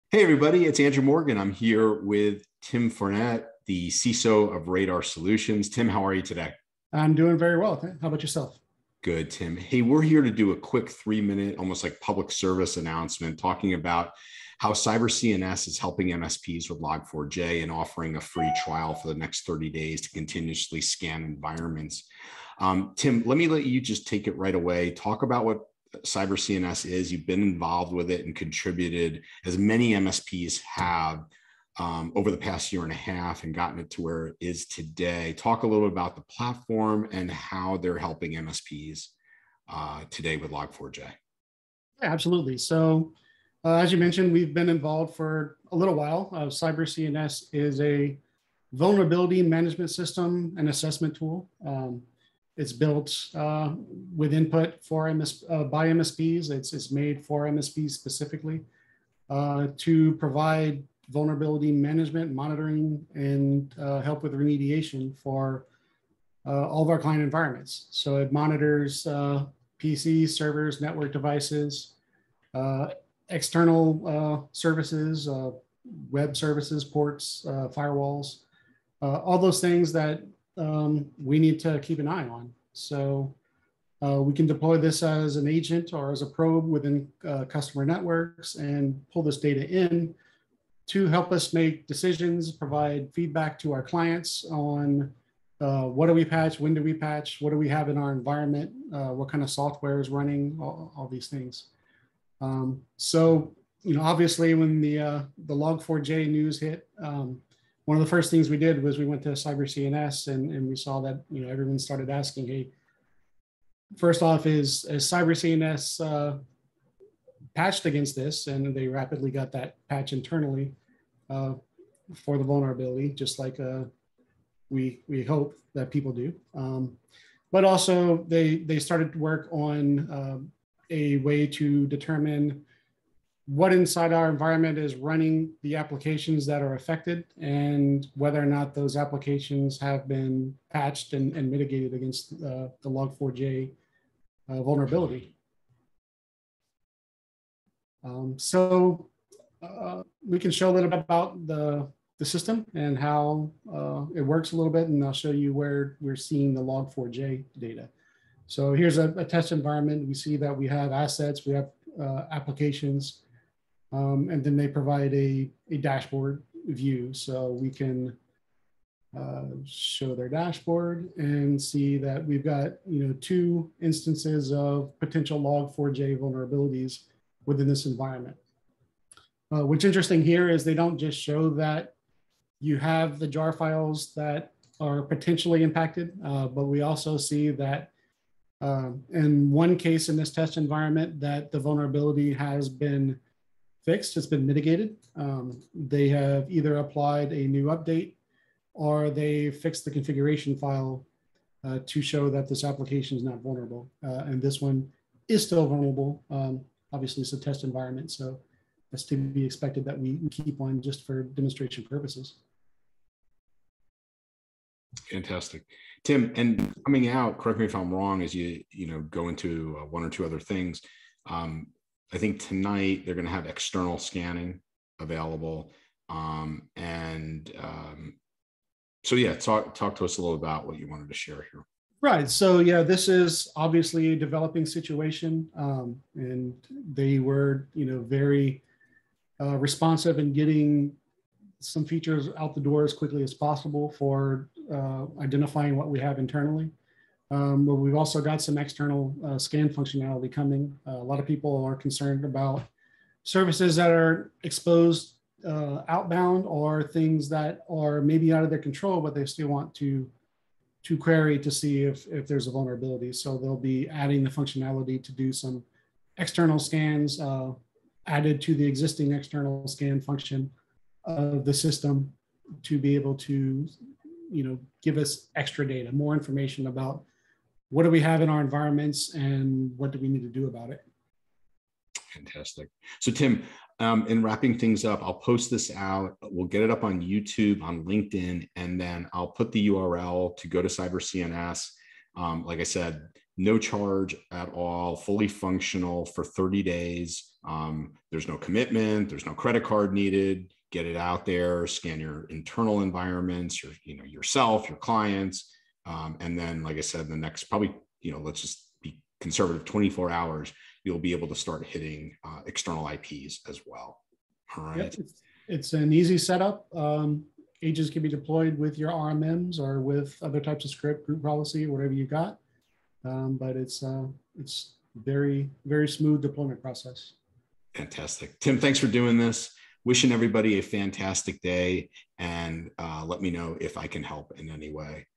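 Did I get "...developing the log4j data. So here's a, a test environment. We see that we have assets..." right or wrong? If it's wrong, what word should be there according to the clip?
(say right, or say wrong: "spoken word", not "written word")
wrong: "seeing", not "developing".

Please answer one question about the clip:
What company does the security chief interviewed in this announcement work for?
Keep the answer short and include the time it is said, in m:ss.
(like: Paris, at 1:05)
Radar Solutions, at 0:04.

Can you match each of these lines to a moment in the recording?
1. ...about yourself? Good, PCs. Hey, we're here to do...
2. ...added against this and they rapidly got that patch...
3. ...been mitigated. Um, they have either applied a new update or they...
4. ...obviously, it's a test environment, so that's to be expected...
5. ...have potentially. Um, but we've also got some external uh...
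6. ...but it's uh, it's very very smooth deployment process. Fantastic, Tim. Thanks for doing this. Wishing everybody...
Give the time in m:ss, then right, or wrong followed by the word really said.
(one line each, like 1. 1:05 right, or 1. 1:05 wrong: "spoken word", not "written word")
1. 0:08 wrong: "Tim", not "PCs"
2. 1:57 wrong: "patched", not "added"
3. 3:14 right
4. 3:26 right
5. 4:05 wrong: "internally", not "potentially"
6. 5:23 right.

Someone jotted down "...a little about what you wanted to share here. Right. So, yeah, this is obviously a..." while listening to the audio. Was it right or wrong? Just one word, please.
right.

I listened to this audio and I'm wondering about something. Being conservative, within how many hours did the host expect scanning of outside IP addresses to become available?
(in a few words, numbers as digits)
24.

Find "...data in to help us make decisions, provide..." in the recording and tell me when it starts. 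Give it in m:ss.
1:29.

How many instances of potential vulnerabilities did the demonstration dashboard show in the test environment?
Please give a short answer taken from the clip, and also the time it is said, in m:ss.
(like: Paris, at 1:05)
2, at 2:53.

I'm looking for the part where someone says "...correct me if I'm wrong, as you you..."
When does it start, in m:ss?
3:37.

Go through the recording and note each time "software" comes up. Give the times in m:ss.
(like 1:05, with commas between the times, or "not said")
1:39.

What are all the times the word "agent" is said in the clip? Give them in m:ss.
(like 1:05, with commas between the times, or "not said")
1:25, 5:17.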